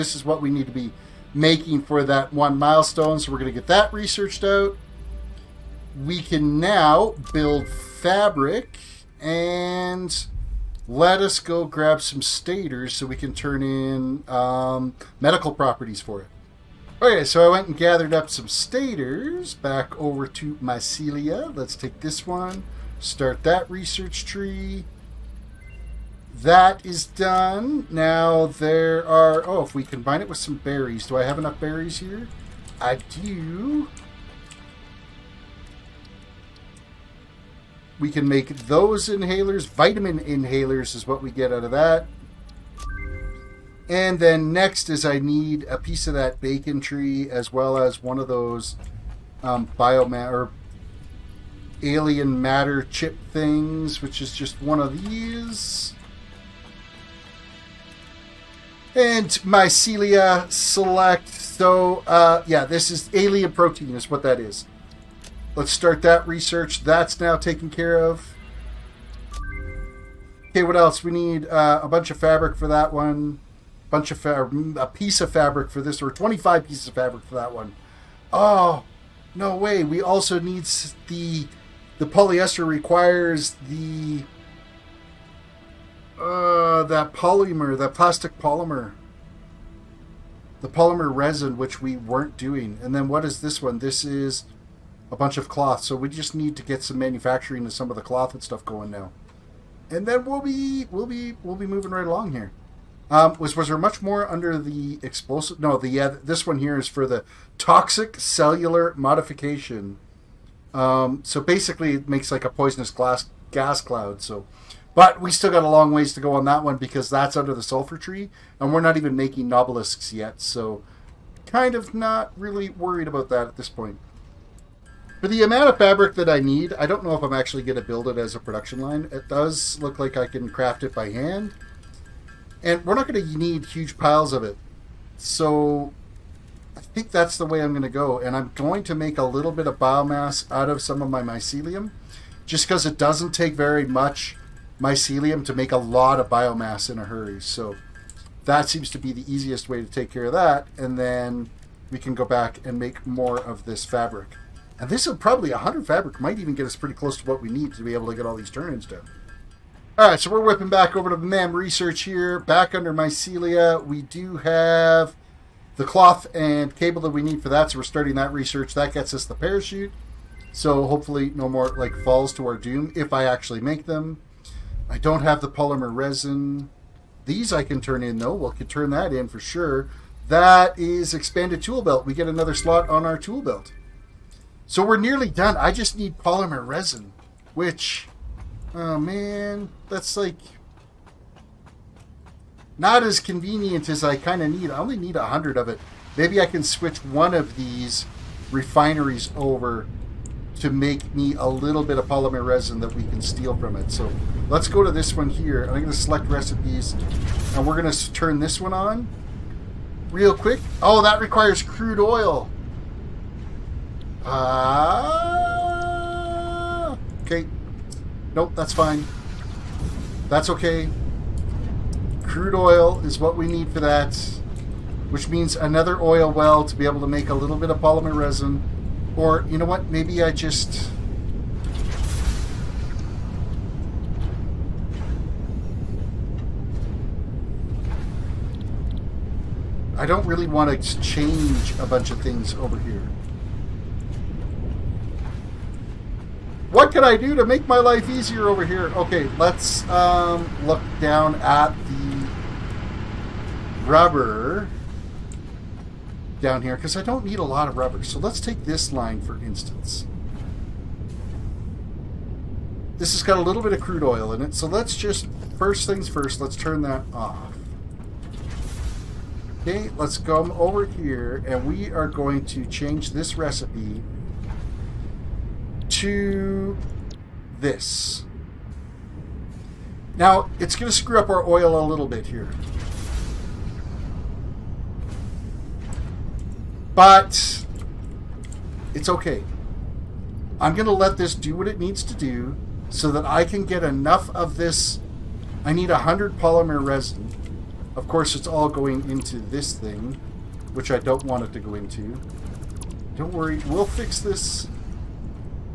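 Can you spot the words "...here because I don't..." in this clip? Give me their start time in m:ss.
4:16.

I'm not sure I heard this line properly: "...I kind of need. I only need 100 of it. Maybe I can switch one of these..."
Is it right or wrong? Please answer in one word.
right.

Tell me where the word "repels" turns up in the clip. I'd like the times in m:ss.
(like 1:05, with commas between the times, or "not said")
not said.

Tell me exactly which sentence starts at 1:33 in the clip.
This is a bunch of cloth.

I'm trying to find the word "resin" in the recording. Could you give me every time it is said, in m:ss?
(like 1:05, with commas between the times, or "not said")
1:31, 2:55, 3:06, 3:22, 3:48, 4:56.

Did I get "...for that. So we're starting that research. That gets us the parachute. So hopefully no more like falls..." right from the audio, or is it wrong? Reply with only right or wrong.
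right.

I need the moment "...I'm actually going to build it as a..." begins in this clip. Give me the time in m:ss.
2:07.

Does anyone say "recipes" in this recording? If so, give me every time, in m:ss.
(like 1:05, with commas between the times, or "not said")
3:26, 4:33.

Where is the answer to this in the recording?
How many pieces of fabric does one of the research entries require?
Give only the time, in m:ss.
1:16.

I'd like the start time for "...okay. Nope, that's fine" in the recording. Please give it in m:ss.
3:37.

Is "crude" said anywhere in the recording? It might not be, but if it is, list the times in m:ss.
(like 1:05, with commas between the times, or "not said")
3:31, 3:42, 4:23.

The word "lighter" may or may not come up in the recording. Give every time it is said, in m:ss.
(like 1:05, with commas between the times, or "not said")
not said.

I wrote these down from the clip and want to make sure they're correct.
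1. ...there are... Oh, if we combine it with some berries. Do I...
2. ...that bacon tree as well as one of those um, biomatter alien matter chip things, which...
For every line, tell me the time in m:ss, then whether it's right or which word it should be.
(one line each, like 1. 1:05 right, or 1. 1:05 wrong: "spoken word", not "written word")
1. 0:28 right
2. 0:46 right.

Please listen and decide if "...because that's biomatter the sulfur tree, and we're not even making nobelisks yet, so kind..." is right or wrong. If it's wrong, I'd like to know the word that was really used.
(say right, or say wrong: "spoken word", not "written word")
wrong: "under", not "biomatter".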